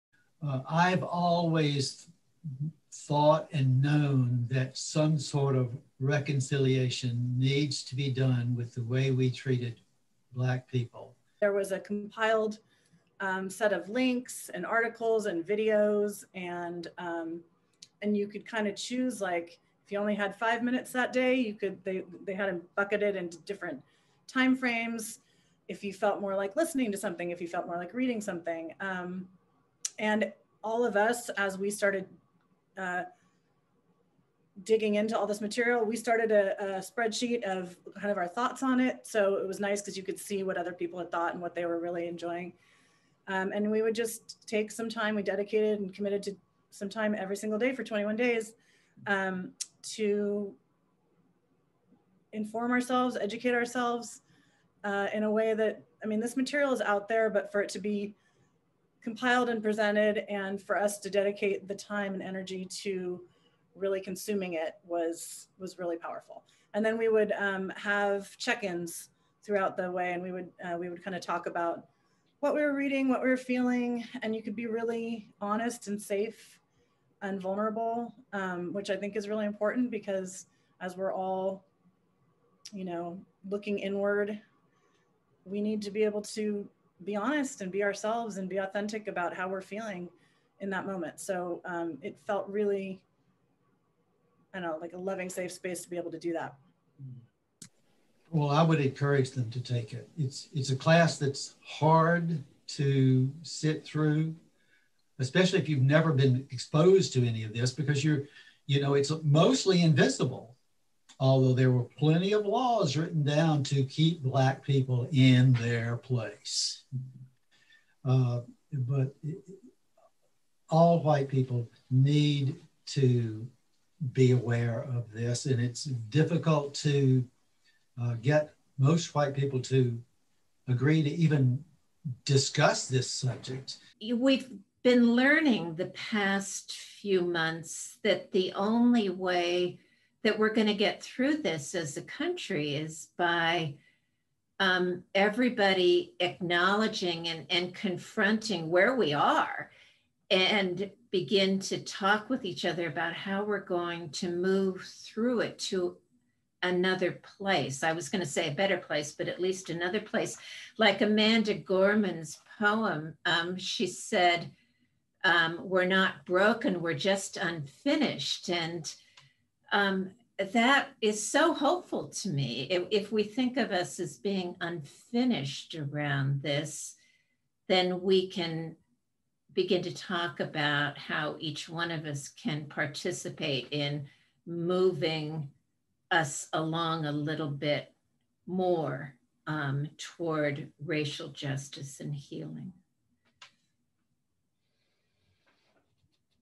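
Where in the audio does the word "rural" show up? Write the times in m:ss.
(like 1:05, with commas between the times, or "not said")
not said.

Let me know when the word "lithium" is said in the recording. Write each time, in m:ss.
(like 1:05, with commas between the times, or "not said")
not said.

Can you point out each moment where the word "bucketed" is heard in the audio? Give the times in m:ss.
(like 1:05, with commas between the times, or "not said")
0:22.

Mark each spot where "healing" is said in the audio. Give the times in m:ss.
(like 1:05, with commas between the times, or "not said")
3:12.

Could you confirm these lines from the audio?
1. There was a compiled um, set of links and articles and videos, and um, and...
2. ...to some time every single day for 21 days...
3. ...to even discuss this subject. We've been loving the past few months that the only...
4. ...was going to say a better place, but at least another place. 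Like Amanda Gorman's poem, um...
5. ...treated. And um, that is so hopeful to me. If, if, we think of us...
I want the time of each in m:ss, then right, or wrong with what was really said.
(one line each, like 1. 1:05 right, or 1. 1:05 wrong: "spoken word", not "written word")
1. 0:11 right
2. 0:46 right
3. 2:11 wrong: "learning", not "loving"
4. 2:37 right
5. 2:47 wrong: "unfinished", not "treated".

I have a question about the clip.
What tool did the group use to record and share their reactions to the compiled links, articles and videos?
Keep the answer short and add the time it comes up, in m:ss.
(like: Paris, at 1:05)
spreadsheet, at 0:36.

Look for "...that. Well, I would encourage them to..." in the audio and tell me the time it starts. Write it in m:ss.
1:36.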